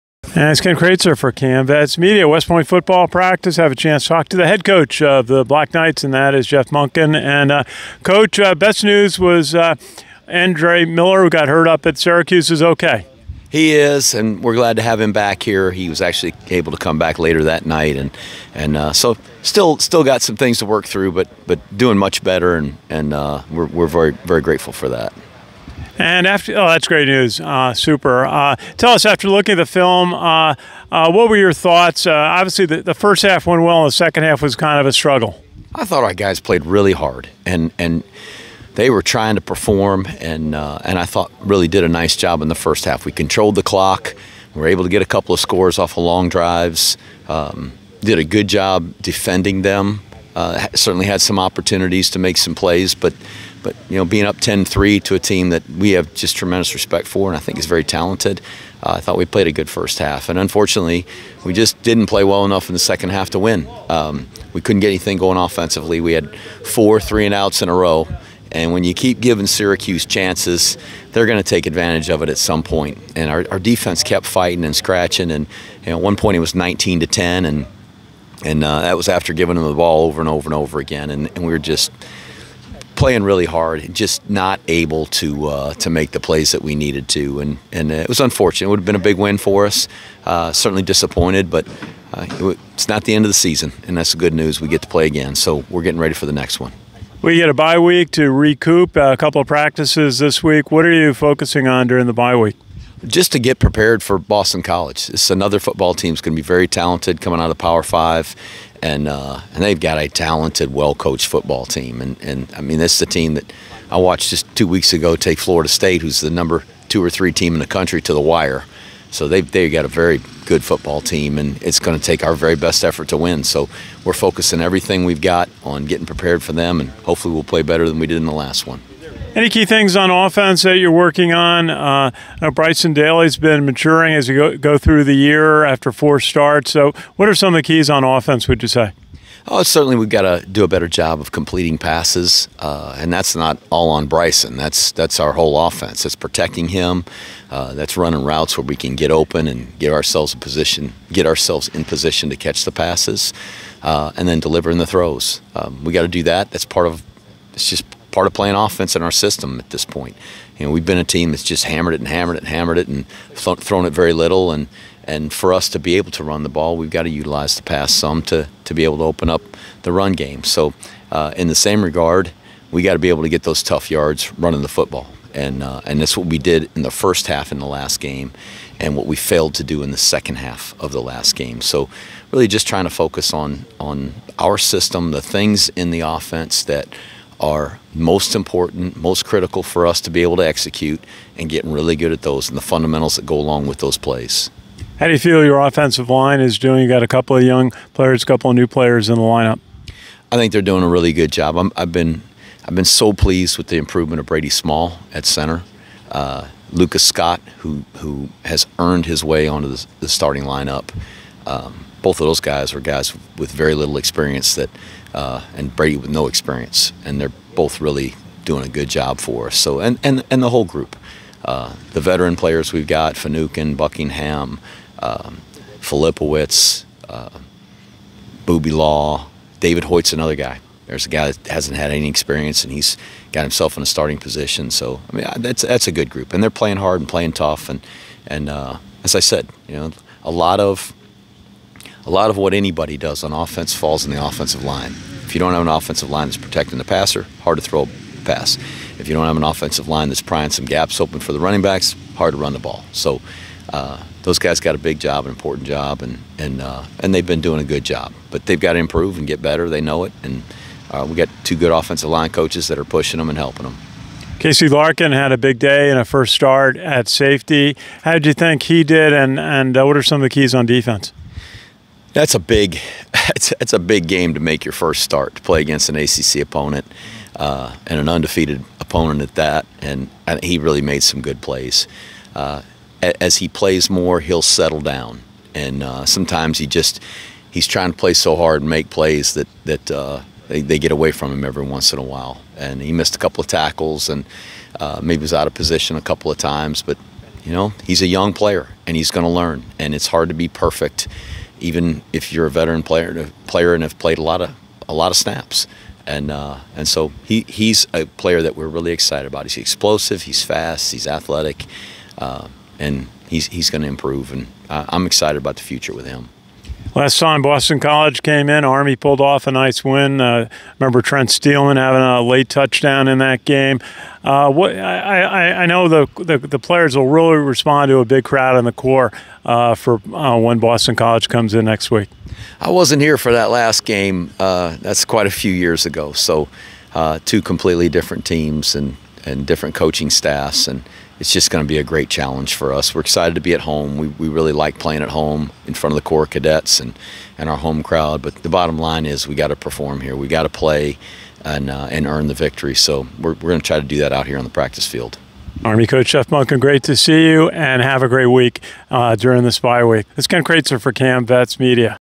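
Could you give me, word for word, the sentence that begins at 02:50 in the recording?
So, uh, in the same regard, we got to be able to get those tough yards running the football.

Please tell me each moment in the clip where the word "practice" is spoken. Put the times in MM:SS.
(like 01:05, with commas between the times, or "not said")
00:03, 01:39, 05:54.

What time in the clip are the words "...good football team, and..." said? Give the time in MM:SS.
02:00.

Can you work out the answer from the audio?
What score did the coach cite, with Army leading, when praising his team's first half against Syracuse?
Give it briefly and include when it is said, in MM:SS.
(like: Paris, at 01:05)
10-3, at 00:54.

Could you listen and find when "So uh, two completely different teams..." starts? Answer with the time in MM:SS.
05:36.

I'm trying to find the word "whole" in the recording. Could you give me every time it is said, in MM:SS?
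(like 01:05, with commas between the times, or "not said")
02:25, 03:40.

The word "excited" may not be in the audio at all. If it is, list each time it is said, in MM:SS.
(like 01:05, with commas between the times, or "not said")
05:08, 05:15, 05:43.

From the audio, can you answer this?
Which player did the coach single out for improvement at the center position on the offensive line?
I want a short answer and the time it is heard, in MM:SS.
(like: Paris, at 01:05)
Brady Small, at 03:24.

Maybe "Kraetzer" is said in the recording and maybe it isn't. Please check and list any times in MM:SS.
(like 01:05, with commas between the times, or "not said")
00:00, 06:00.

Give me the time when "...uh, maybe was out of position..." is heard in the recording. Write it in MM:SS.
04:54.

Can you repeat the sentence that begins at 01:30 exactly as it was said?
Uh, certainly disappointed, but uh, it's not the end of the season, and that's the good news.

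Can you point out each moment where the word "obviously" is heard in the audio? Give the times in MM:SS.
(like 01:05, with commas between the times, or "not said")
00:32.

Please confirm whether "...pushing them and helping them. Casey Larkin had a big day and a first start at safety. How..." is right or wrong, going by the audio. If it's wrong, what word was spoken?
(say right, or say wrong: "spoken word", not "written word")
right.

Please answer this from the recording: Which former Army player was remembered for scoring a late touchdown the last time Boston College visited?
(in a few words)
Trent Steelman.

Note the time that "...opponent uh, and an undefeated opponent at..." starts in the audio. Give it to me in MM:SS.
04:36.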